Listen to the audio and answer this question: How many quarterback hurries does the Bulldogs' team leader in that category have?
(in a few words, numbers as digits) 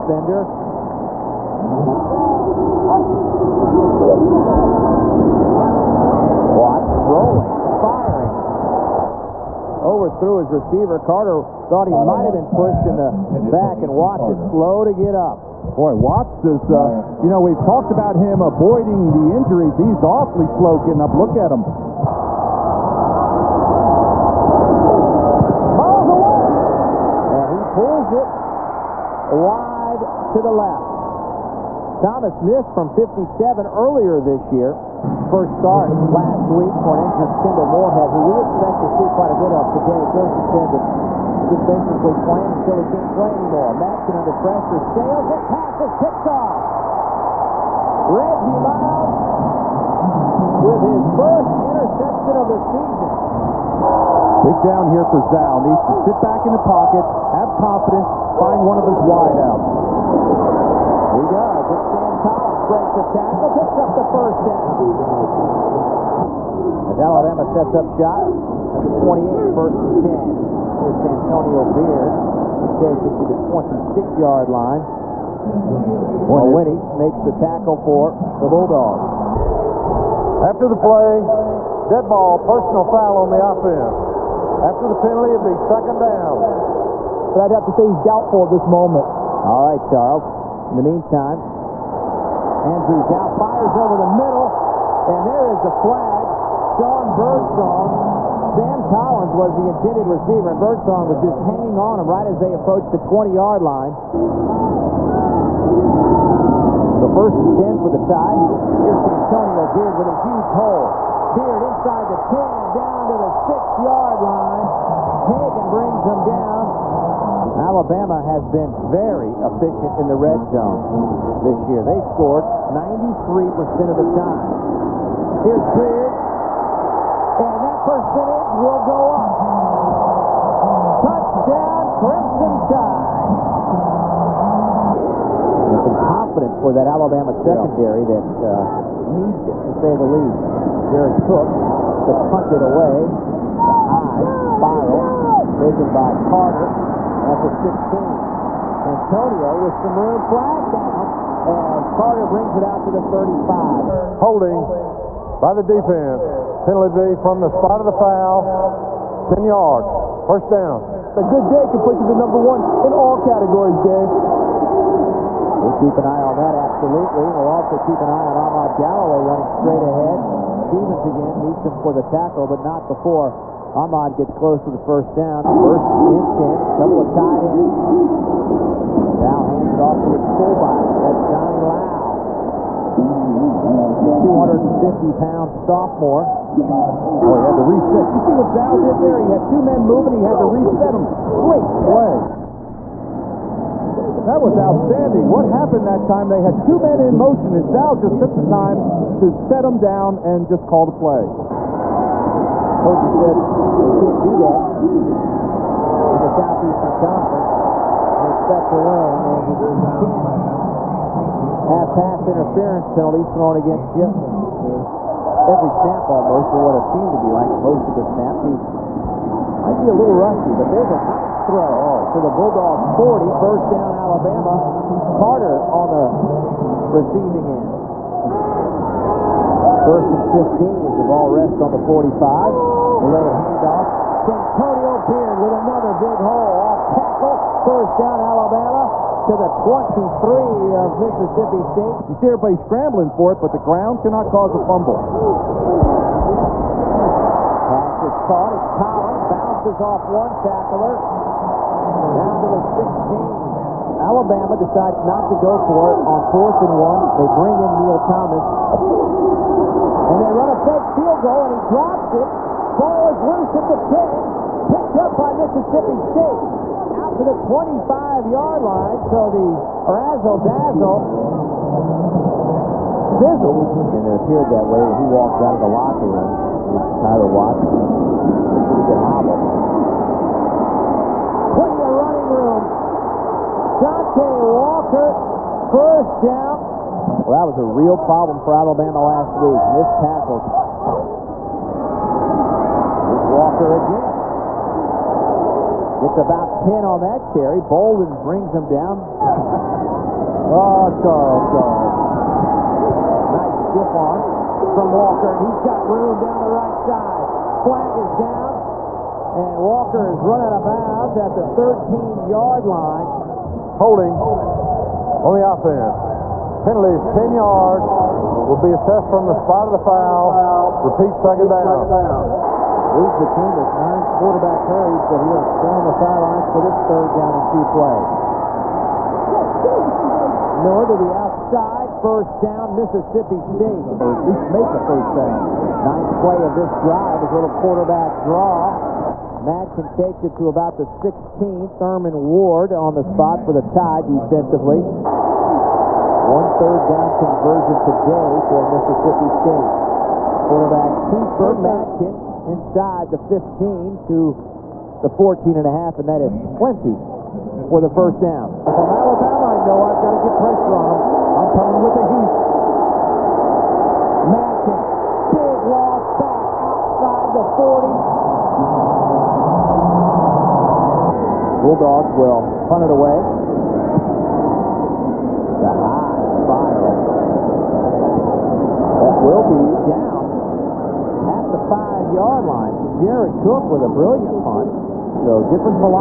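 9.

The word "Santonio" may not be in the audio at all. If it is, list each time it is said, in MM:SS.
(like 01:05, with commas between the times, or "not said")
01:10, 03:54.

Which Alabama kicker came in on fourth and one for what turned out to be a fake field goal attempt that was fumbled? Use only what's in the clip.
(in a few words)
Neil Thomas.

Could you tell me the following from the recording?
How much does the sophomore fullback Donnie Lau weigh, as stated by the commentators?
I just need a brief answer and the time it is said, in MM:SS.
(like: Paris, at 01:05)
250 pounds, at 03:04.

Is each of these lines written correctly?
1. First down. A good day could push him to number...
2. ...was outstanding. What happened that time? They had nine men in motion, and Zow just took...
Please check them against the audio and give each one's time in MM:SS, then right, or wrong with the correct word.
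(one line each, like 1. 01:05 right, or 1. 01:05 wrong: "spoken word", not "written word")
1. 02:40 right
2. 03:14 wrong: "two", not "nine".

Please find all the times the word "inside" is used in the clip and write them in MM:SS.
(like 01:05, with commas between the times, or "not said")
01:51, 05:52.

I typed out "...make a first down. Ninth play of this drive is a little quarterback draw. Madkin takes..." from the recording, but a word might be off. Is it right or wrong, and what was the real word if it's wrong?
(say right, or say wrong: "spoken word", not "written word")
right.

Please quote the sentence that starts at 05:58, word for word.
If I'm Alabama, I know I've got to get pressure on them.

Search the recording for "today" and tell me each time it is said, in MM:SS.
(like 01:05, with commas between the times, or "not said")
00:39, 05:47.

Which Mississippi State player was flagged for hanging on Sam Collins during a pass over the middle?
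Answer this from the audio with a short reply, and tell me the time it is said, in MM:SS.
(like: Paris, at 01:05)
Sean Birdsong, at 01:36.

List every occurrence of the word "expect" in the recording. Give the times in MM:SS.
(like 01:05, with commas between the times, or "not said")
00:38, 03:28.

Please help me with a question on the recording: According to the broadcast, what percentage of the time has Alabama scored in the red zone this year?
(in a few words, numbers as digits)
93%.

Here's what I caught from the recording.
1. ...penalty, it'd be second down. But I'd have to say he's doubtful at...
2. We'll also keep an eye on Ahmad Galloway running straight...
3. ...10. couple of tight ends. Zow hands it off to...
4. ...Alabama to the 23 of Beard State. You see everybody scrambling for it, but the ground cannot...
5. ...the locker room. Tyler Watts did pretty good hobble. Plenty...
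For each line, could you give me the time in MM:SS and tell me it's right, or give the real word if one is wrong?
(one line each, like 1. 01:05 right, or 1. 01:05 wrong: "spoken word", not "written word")
1. 01:25 right
2. 02:47 right
3. 02:56 right
4. 03:58 wrong: "Mississippi", not "Beard"
5. 04:35 right.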